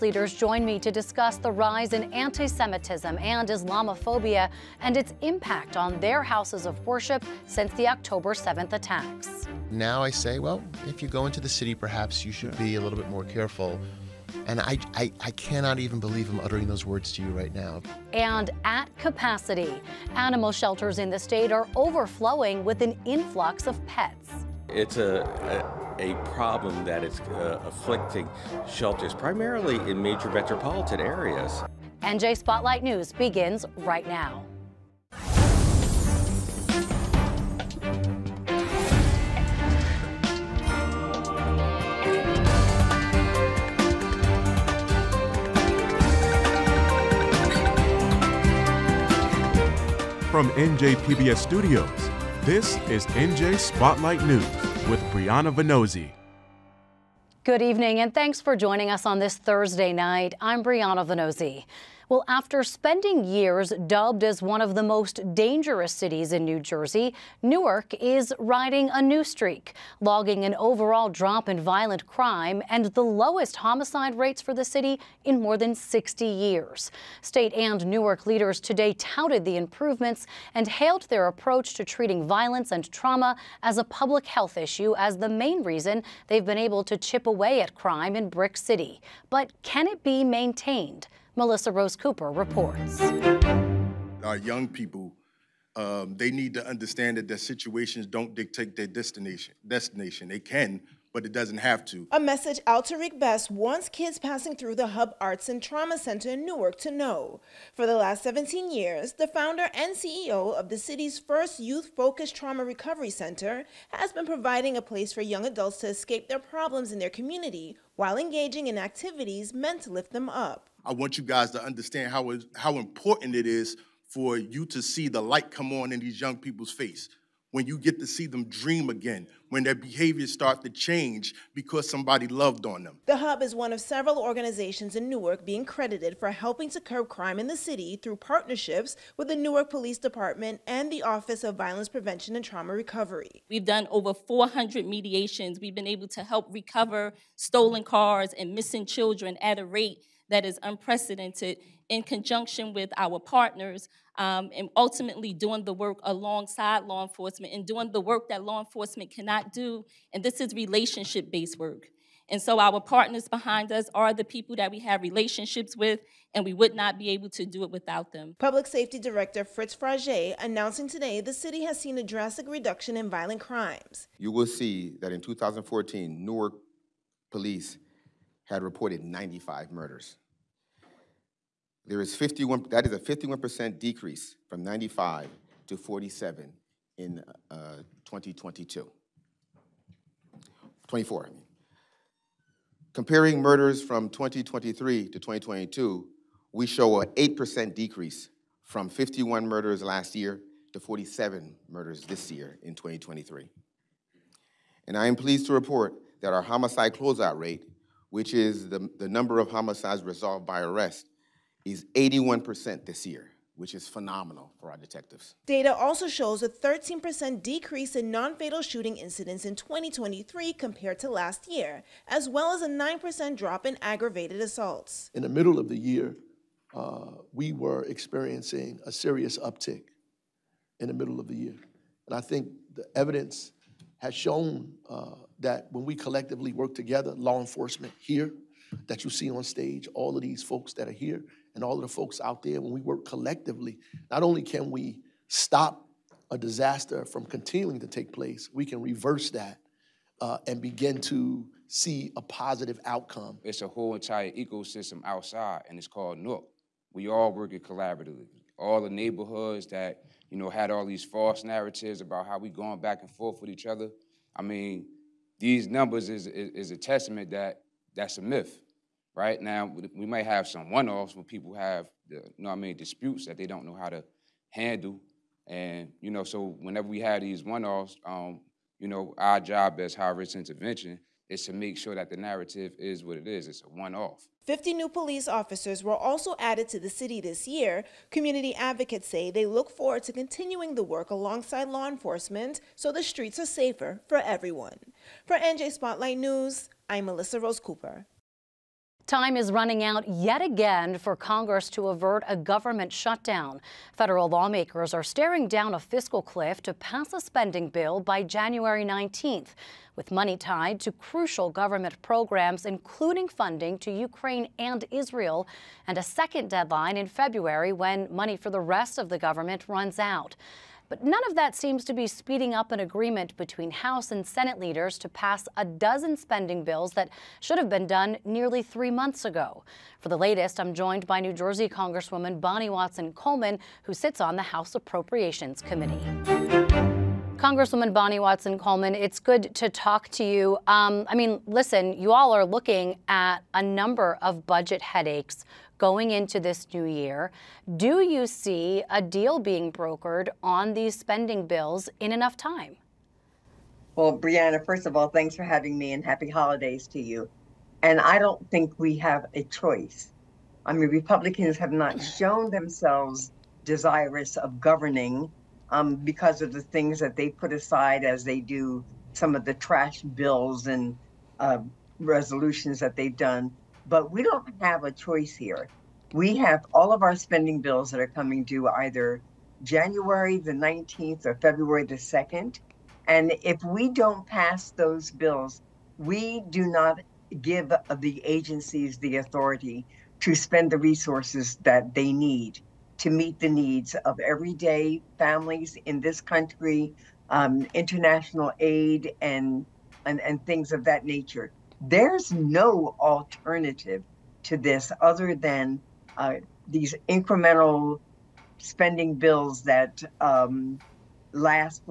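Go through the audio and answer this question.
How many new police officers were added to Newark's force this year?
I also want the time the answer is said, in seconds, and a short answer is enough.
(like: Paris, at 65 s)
50, at 284 s.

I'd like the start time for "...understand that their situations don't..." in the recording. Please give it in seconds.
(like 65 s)
96 s.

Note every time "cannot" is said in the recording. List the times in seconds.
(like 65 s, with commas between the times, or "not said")
15 s, 159 s.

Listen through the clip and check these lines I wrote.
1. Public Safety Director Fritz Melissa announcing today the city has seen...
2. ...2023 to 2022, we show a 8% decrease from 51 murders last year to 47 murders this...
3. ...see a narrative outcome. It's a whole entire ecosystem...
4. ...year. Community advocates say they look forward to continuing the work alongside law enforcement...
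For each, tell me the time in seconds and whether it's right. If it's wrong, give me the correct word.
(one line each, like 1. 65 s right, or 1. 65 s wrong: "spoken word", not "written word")
1. 168 s wrong: "Fragé", not "Melissa"
2. 194 s right
3. 251 s wrong: "positive", not "narrative"
4. 287 s right.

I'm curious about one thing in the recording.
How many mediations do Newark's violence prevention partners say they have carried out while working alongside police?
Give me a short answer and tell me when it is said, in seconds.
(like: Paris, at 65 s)
Over 400, at 143 s.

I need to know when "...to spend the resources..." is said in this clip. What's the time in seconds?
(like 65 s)
390 s.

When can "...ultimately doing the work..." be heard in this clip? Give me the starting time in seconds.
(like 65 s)
154 s.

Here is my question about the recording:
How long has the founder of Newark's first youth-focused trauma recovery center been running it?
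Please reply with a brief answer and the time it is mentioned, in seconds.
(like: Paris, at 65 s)
17 years, at 108 s.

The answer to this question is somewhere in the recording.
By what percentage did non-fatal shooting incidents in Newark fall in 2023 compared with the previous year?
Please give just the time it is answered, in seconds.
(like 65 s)
216 s.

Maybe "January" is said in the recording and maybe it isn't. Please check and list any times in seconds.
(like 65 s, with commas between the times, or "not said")
308 s, 379 s.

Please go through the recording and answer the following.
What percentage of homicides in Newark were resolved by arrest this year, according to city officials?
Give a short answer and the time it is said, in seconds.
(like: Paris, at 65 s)
81%, at 211 s.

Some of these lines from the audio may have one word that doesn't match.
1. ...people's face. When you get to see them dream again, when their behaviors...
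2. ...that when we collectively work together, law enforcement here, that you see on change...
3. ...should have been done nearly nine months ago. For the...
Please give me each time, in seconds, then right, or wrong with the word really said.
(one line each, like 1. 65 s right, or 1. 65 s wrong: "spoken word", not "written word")
1. 126 s right
2. 235 s wrong: "stage", not "change"
3. 327 s wrong: "three", not "nine".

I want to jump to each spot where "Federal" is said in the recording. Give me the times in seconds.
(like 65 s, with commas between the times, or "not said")
303 s.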